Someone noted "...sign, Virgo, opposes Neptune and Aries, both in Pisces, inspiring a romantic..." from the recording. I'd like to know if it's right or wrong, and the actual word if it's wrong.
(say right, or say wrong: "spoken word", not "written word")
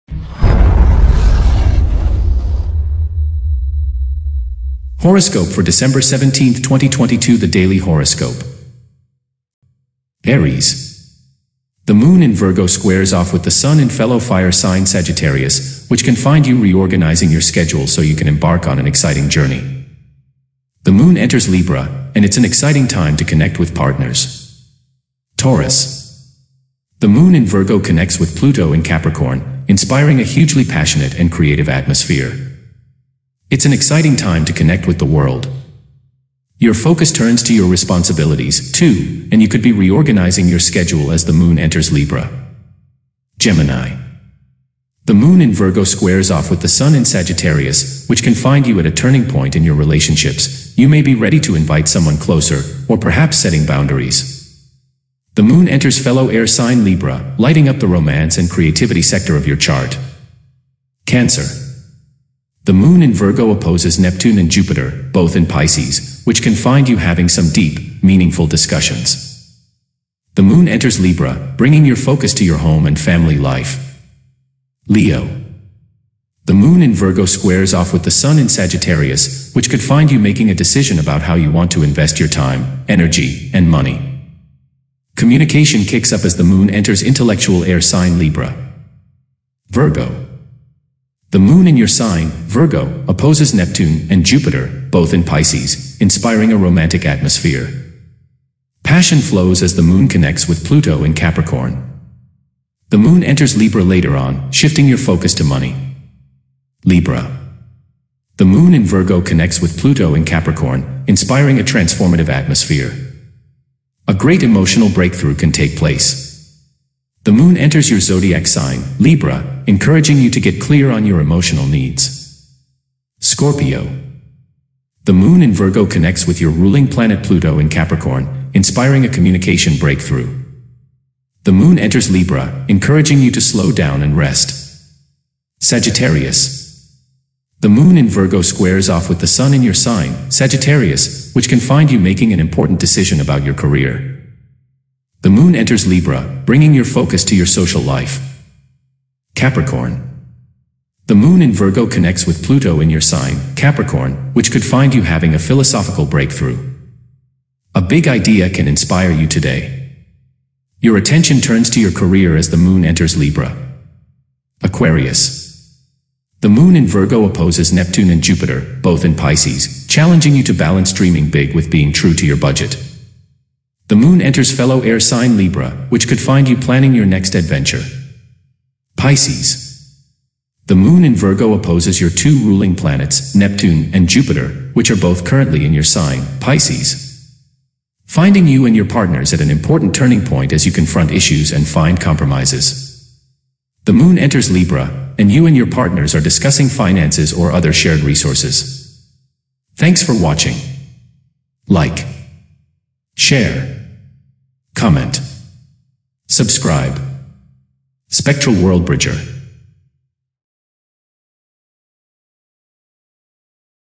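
wrong: "Jupiter", not "Aries".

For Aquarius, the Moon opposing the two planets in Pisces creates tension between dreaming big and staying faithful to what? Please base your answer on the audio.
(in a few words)
your budget.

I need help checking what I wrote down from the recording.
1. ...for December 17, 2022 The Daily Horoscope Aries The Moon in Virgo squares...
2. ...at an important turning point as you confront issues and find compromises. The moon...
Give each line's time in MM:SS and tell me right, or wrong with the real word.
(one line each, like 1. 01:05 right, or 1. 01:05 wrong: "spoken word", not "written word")
1. 00:05 right
2. 03:09 right.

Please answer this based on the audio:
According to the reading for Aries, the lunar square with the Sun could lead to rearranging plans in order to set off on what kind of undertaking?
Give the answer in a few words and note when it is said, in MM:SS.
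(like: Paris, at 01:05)
an exciting journey, at 00:18.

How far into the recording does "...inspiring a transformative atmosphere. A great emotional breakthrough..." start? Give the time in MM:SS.
01:51.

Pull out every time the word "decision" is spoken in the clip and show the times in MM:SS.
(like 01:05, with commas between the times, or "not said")
01:20, 02:22.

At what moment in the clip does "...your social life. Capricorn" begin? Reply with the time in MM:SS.
02:27.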